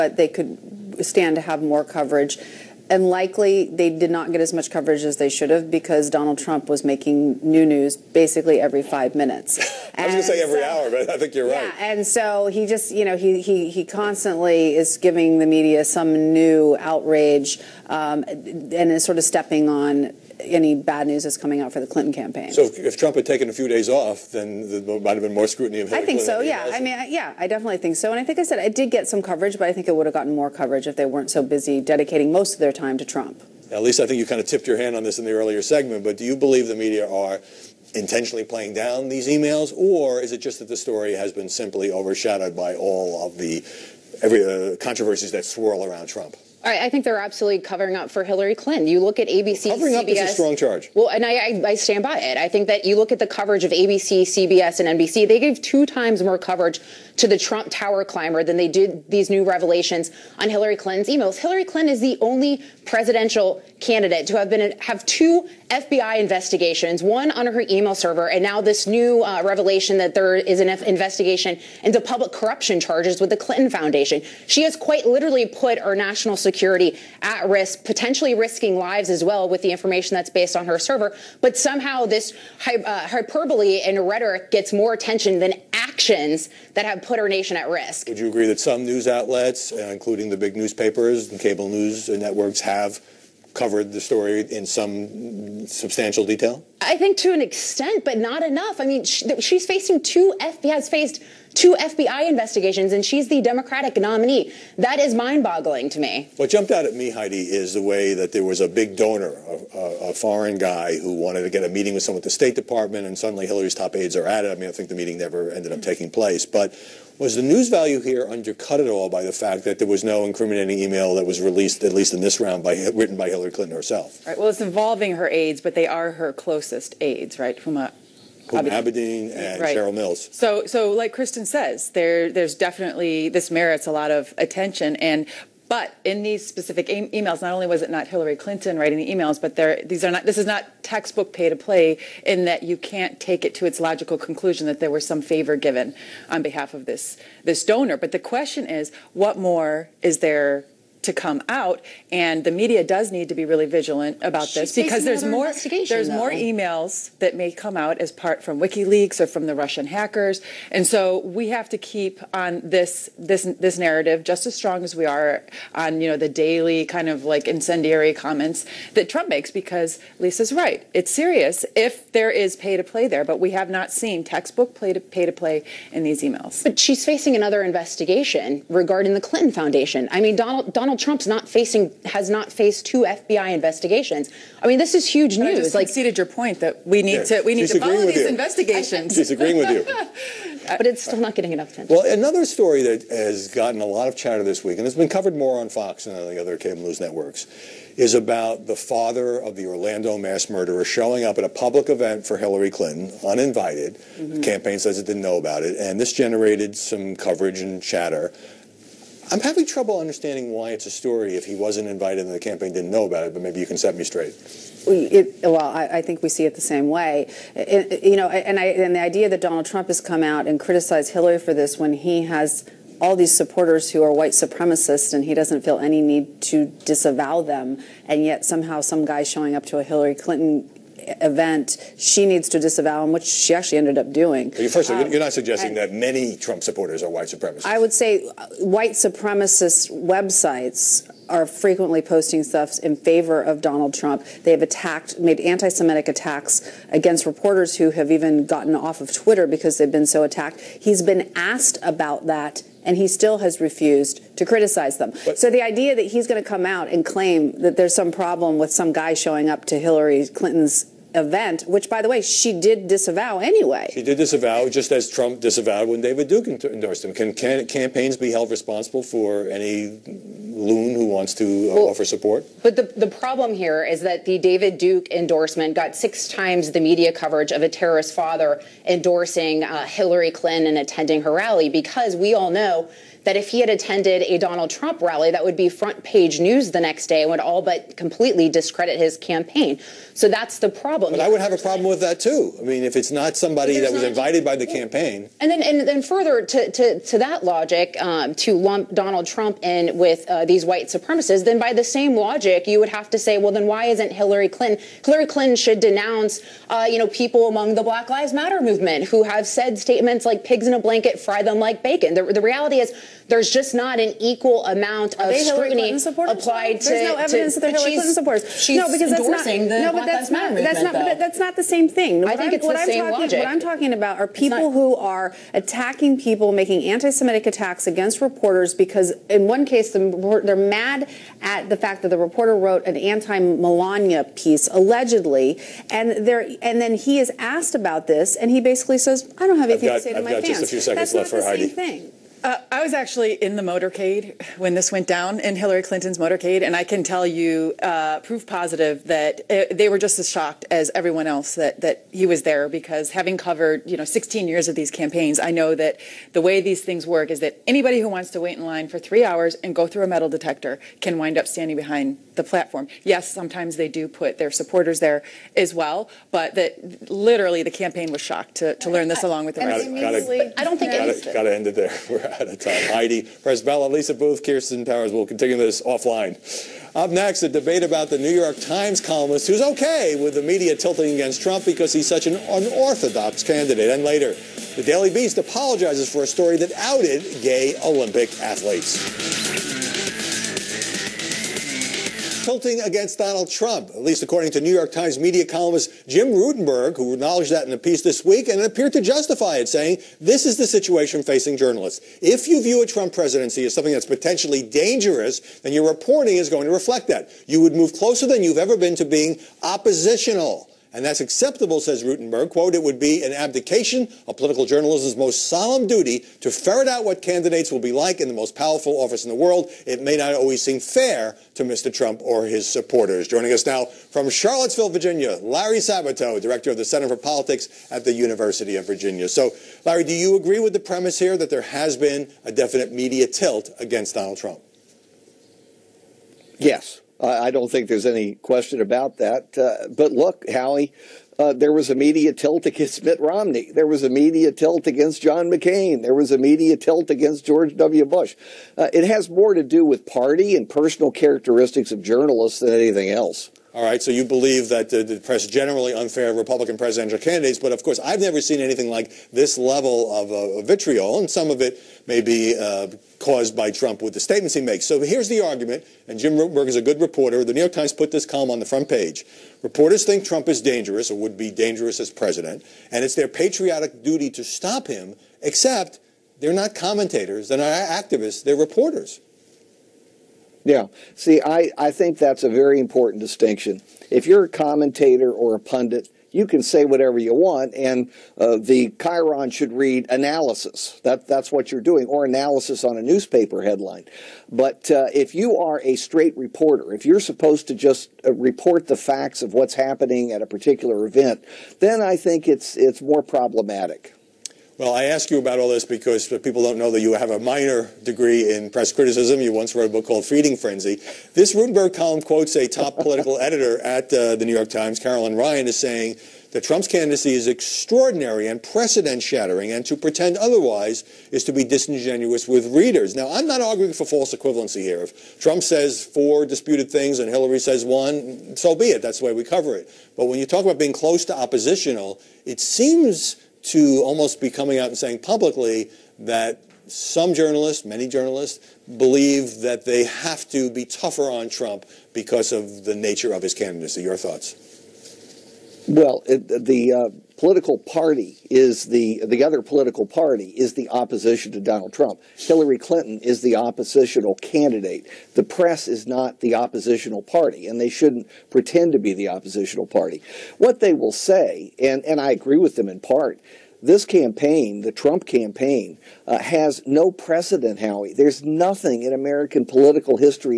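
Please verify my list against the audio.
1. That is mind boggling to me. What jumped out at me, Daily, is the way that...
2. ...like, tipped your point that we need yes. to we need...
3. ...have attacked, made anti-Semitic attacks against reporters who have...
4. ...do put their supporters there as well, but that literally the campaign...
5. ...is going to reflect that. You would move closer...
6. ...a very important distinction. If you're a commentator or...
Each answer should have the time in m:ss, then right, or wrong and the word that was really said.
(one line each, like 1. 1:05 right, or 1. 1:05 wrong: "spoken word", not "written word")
1. 1:44 wrong: "Heidi", not "Daily"
2. 3:05 wrong: "conceded", not "tipped"
3. 4:04 right
4. 6:03 right
5. 6:46 right
6. 8:02 right.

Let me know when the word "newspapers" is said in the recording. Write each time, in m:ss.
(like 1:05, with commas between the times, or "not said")
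1:30, 8:13.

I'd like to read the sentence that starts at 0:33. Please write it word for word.
At least I think you kind of tipped your hand on this in the earlier segment.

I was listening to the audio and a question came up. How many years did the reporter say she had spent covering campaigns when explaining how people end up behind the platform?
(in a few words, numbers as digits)
16.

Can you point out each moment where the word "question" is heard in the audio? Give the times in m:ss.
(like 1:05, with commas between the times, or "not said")
2:28, 7:18.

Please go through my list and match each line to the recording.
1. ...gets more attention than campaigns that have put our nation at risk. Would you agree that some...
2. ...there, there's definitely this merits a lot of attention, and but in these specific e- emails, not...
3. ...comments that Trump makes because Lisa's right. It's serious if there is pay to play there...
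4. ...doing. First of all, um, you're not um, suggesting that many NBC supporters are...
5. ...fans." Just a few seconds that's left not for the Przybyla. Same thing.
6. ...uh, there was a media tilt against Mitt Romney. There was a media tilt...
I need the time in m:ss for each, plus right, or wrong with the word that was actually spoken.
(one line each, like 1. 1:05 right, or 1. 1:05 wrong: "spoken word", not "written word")
1. 1:24 wrong: "actions", not "campaigns"
2. 2:11 right
3. 2:48 right
4. 3:54 wrong: "Trump", not "NBC"
5. 5:40 wrong: "Heidi", not "Przybyla"
6. 7:21 right.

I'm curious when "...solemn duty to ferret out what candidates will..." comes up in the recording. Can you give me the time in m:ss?
6:55.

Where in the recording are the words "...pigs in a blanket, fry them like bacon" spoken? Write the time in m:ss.
5:10.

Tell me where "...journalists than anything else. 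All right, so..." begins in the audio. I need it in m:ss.
7:32.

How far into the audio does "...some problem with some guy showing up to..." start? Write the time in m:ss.
4:17.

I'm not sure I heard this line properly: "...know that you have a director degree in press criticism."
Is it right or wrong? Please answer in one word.
wrong.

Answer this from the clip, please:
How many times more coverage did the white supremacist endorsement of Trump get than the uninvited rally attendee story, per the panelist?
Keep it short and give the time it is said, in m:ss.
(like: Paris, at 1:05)
6, at 4:35.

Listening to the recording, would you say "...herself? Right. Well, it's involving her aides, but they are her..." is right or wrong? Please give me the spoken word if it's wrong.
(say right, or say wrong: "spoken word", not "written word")
right.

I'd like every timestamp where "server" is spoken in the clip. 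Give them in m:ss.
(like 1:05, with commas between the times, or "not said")
1:07, 1:20.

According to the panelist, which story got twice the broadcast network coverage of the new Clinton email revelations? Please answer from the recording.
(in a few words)
Trump tower climber.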